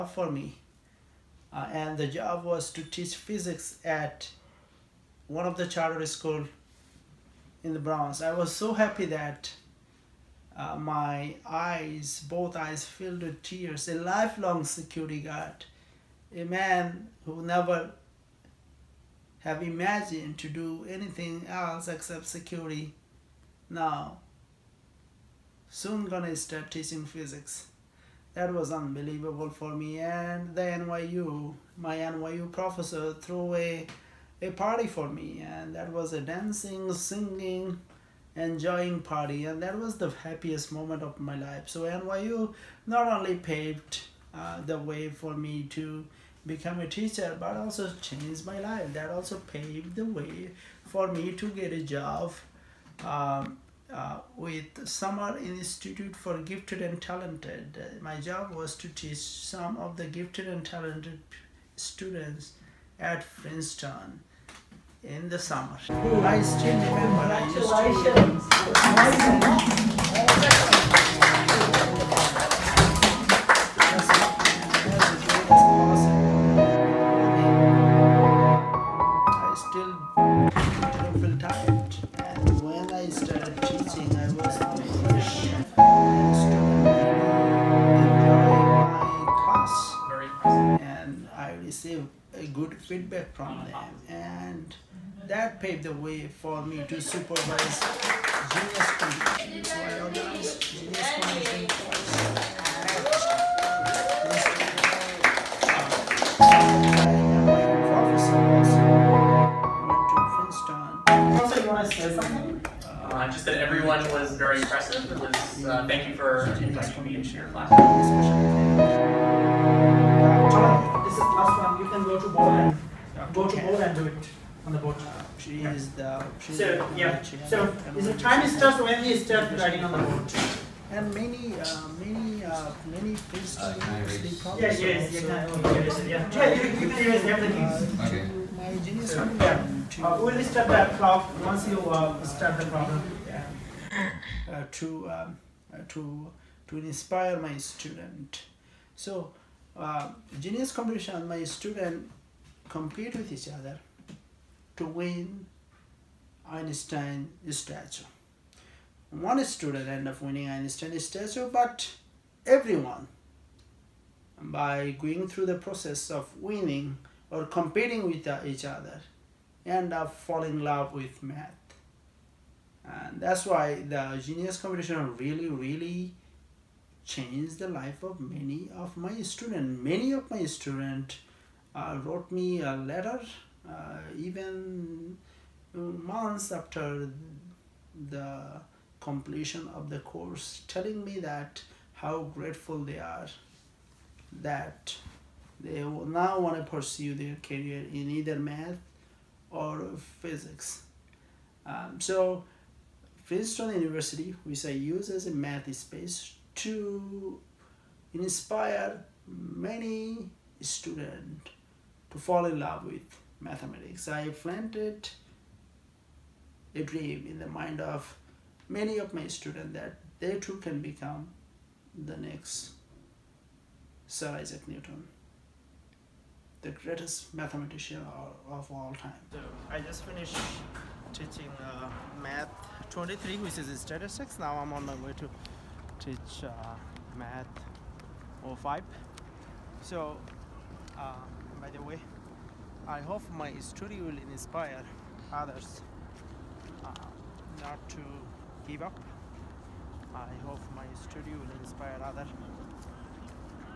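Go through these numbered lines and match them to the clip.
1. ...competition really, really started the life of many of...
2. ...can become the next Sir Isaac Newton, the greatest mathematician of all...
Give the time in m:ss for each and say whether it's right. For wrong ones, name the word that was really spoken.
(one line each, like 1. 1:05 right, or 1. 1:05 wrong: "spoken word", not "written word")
1. 2:54 wrong: "changed", not "started"
2. 3:40 right.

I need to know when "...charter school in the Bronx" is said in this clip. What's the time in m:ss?
0:05.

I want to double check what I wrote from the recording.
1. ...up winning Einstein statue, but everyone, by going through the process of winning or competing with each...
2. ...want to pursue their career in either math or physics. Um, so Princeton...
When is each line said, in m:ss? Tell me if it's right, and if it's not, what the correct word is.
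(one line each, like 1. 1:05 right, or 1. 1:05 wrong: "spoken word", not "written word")
1. 2:40 right
2. 3:16 right.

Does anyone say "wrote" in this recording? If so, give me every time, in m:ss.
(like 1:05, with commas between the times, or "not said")
3:02.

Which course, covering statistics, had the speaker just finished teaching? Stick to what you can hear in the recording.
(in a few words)
Math 23.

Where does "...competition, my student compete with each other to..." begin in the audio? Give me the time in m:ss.
2:30.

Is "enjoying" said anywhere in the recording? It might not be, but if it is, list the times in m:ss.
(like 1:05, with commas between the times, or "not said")
0:38.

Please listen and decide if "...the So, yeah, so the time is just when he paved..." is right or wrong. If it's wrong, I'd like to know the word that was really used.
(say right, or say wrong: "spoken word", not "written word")
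wrong: "started", not "paved".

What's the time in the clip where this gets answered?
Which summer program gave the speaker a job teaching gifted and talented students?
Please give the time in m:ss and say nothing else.
0:54.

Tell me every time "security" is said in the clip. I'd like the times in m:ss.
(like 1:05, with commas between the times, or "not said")
0:14, 0:22.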